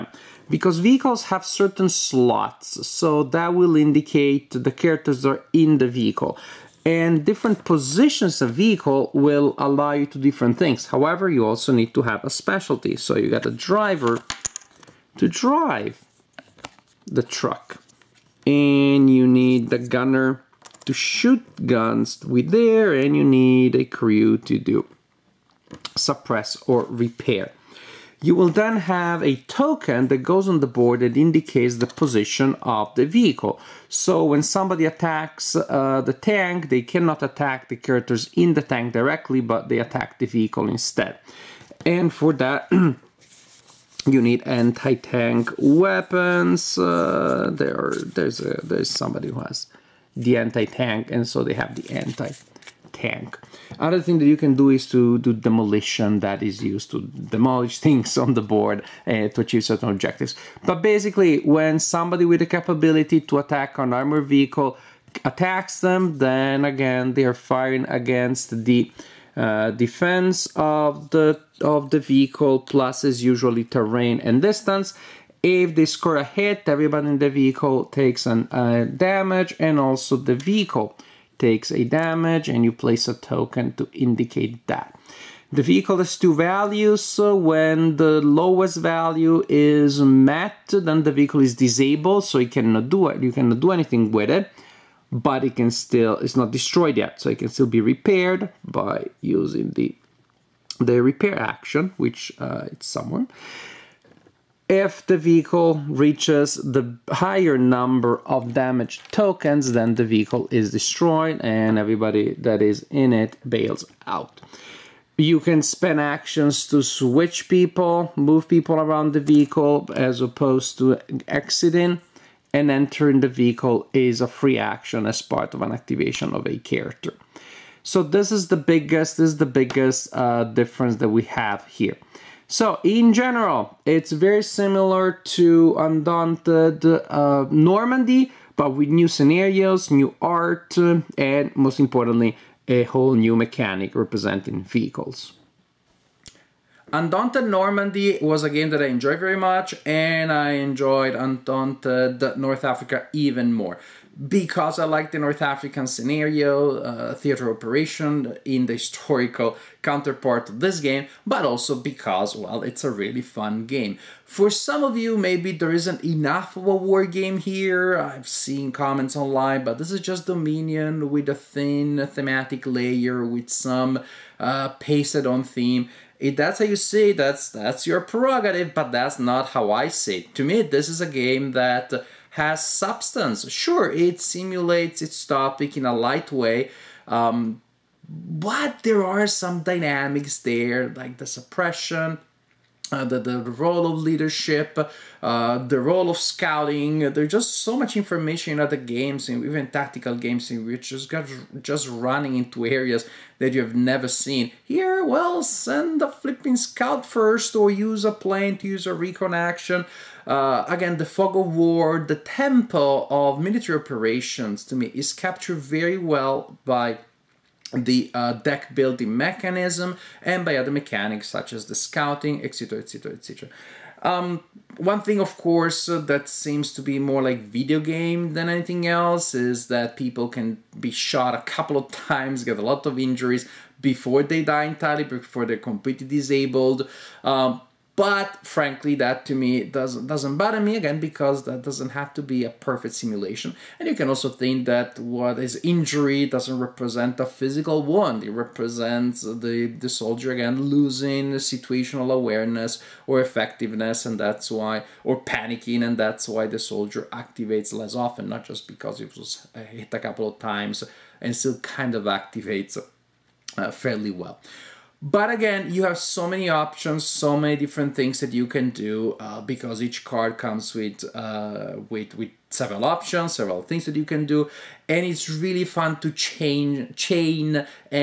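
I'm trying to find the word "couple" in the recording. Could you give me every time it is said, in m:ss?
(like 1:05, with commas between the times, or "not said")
3:51, 4:19.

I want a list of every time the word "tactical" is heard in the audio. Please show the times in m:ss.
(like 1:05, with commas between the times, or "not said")
3:19.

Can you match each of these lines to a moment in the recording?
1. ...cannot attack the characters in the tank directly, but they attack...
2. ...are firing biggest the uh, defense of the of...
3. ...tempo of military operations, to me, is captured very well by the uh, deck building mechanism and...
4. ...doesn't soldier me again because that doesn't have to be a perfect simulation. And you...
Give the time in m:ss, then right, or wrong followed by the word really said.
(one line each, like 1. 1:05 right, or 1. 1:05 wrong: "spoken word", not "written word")
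1. 0:36 right
2. 1:07 wrong: "against", not "biggest"
3. 3:32 right
4. 4:00 wrong: "bother", not "soldier".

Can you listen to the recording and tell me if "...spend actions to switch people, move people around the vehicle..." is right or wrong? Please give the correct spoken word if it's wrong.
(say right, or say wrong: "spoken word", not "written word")
right.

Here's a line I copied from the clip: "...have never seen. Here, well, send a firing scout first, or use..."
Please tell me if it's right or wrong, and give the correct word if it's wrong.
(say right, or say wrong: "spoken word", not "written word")
wrong: "flipping", not "firing".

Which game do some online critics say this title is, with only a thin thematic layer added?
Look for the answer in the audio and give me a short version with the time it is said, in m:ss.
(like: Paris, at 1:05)
Dominion, at 2:50.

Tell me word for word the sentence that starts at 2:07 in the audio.
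So this is the biggest, this is the biggest uh, difference that we have here.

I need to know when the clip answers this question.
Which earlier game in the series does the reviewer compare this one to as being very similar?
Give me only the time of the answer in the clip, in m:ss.
2:15.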